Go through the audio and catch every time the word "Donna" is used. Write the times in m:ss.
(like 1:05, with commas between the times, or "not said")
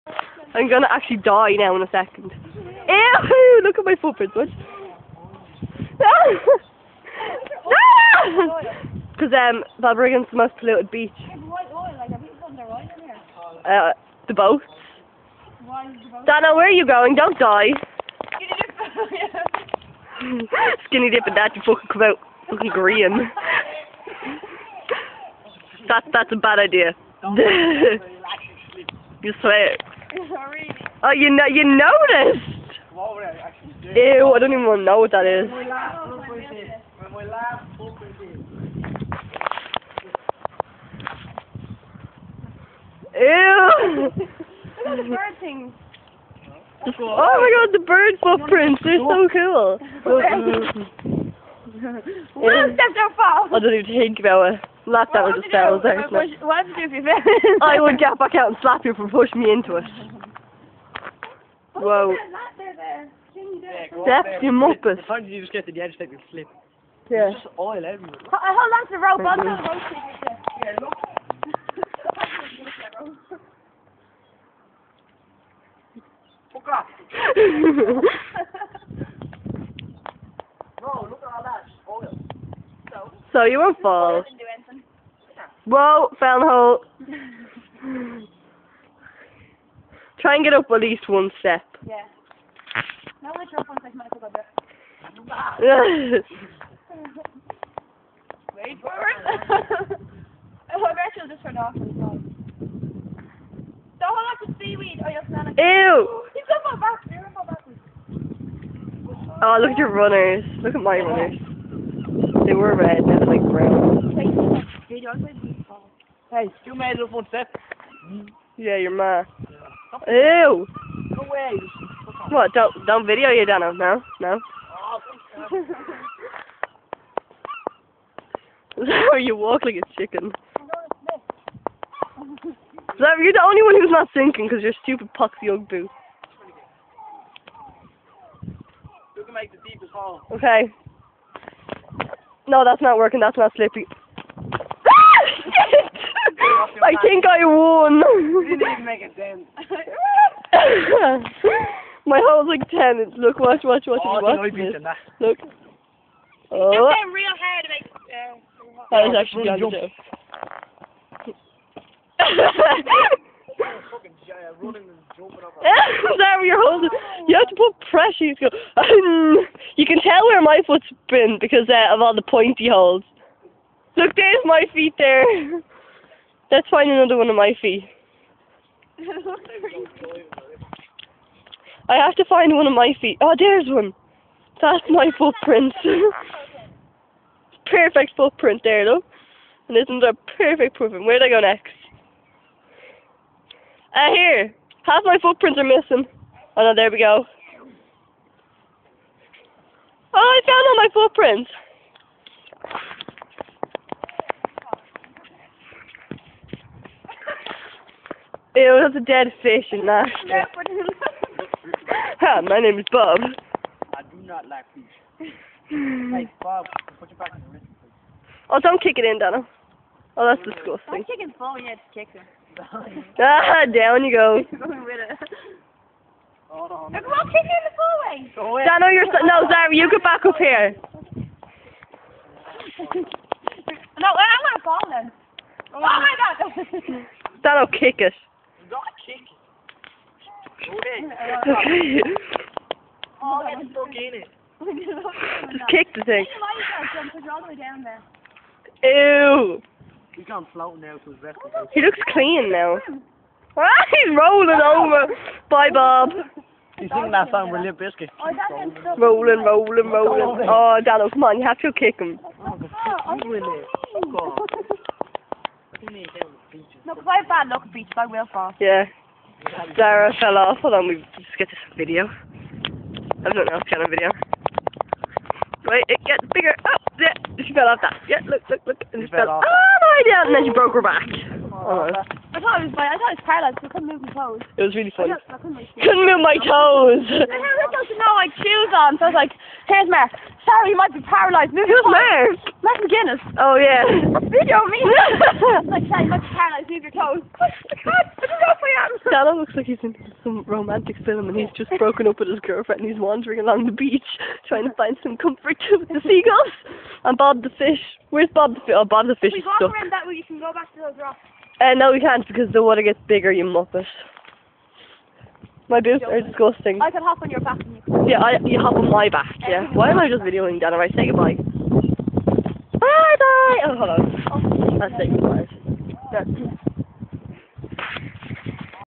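0:16, 3:39.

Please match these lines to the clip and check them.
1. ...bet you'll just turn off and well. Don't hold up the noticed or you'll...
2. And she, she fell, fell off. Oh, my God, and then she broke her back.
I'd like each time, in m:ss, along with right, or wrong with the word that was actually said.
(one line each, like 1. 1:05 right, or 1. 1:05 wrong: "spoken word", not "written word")
1. 1:40 wrong: "seaweed", not "noticed"
2. 4:38 right.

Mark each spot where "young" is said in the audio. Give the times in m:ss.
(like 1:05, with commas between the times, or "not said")
2:15.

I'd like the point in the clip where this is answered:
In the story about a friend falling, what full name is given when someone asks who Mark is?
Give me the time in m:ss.
4:52.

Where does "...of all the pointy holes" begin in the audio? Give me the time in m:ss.
2:51.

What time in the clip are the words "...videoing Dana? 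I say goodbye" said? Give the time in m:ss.
5:20.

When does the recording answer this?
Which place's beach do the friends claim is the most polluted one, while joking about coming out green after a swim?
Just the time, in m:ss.
0:09.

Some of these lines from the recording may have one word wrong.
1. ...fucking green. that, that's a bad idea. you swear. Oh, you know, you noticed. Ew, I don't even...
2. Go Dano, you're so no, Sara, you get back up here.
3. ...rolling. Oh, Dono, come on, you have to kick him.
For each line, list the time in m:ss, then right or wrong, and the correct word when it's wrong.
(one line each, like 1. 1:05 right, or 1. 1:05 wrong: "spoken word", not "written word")
1. 0:22 right
2. 3:48 right
3. 4:19 wrong: "Dano", not "Dono".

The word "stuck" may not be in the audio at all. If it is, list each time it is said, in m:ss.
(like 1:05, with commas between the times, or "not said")
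4:03, 5:09.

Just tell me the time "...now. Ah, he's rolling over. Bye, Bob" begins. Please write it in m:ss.
4:12.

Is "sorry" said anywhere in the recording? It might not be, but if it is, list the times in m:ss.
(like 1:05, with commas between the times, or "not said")
2:46, 4:50, 4:55.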